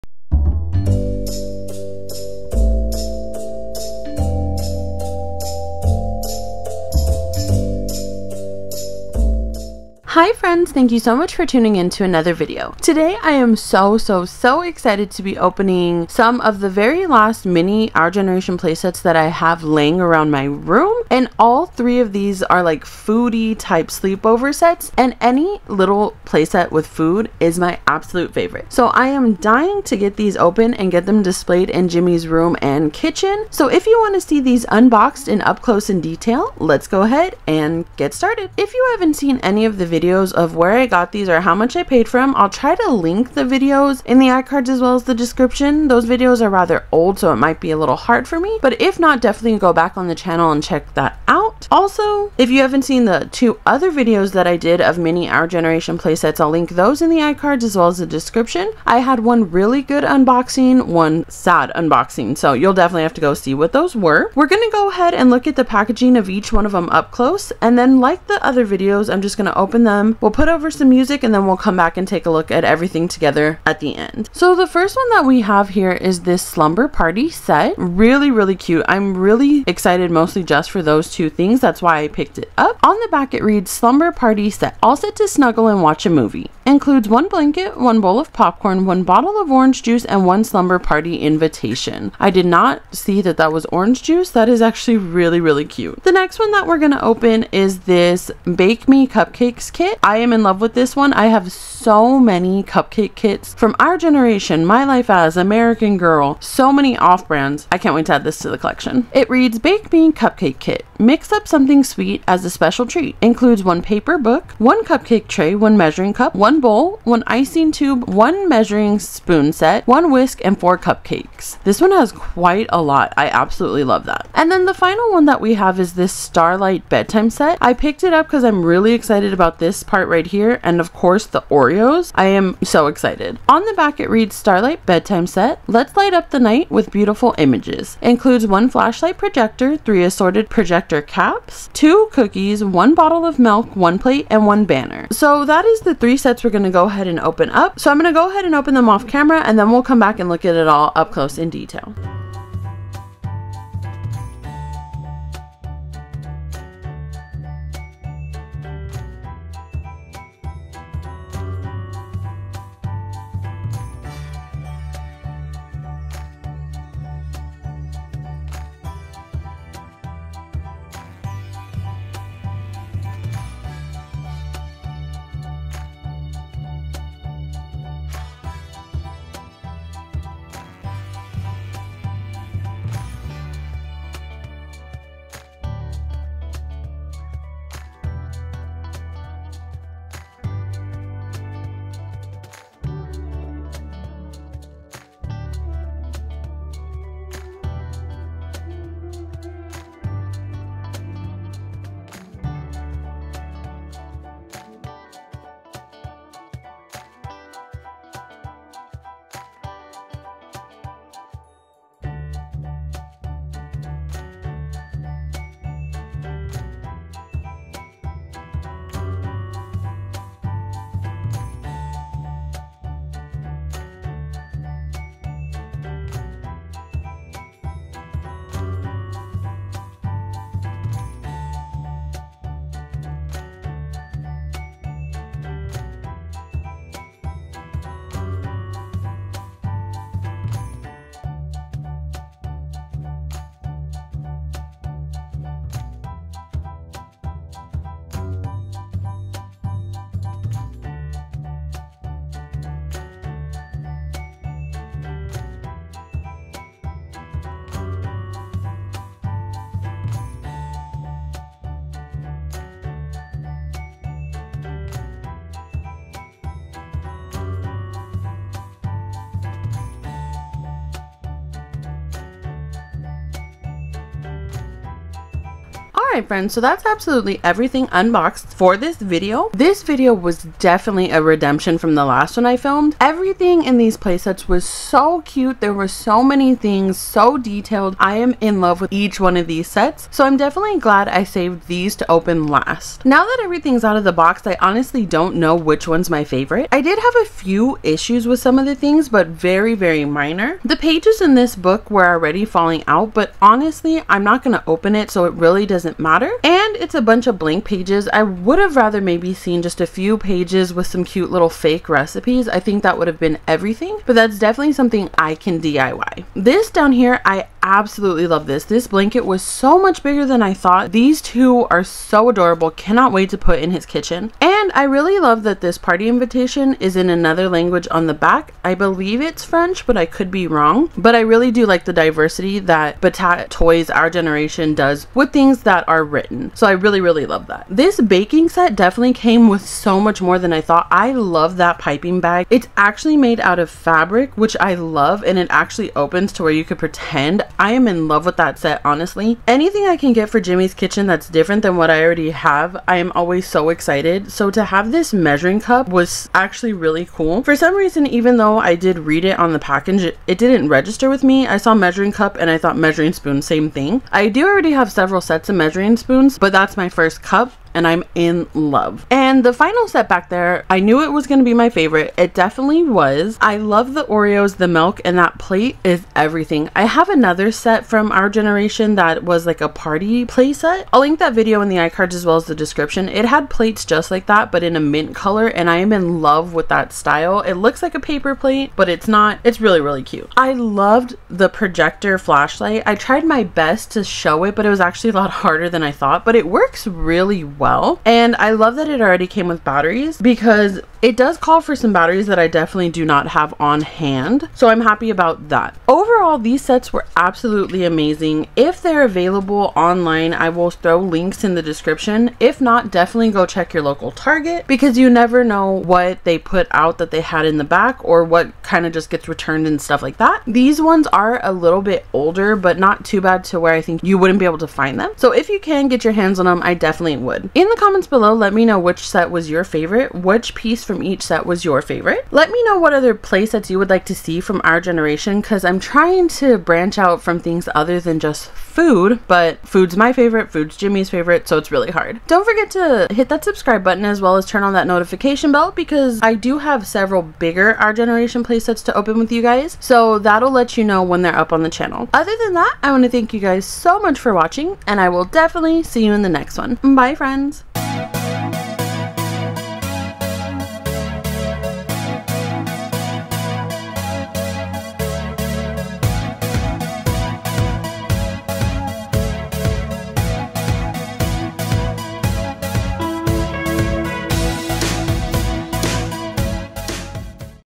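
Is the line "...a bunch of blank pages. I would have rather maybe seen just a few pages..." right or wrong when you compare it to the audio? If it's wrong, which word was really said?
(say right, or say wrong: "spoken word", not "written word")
right.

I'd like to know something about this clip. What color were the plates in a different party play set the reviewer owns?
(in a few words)
mint.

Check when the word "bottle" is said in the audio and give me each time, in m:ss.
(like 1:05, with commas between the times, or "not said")
1:29, 2:22.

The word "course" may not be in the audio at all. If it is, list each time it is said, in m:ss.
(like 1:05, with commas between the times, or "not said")
2:10.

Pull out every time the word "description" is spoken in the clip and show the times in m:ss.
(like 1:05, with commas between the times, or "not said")
0:45, 0:58, 6:22, 6:51.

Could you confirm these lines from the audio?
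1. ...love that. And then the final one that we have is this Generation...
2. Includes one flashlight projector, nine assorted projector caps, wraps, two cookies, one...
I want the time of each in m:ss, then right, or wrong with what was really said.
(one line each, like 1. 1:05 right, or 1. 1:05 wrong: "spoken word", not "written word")
1. 2:03 wrong: "Starlight", not "Generation"
2. 2:18 wrong: "three", not "nine".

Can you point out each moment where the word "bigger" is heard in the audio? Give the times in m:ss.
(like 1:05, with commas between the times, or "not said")
5:20, 7:27.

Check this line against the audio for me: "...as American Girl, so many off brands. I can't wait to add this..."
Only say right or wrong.
right.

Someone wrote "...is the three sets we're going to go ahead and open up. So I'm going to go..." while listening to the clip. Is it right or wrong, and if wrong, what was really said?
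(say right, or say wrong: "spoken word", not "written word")
right.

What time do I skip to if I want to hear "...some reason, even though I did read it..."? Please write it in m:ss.
5:57.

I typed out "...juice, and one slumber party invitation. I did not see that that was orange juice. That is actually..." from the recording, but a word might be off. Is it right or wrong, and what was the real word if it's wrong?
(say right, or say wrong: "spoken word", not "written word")
right.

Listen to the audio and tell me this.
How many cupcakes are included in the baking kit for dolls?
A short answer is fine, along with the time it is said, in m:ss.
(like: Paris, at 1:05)
4, at 2:00.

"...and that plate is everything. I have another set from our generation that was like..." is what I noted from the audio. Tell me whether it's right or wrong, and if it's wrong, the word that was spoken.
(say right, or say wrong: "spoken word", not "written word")
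right.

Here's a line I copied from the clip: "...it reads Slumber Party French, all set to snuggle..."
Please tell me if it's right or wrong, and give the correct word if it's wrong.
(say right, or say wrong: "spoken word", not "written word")
wrong: "Set", not "French".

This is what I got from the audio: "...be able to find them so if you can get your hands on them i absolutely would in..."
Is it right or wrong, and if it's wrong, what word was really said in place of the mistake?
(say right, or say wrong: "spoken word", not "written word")
wrong: "definitely", not "absolutely".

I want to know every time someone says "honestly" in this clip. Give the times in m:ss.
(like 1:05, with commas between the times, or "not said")
4:54, 5:03, 5:48.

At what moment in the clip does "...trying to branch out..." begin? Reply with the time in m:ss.
7:16.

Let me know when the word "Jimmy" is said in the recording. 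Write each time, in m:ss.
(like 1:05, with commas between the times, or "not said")
0:31, 5:50, 7:20.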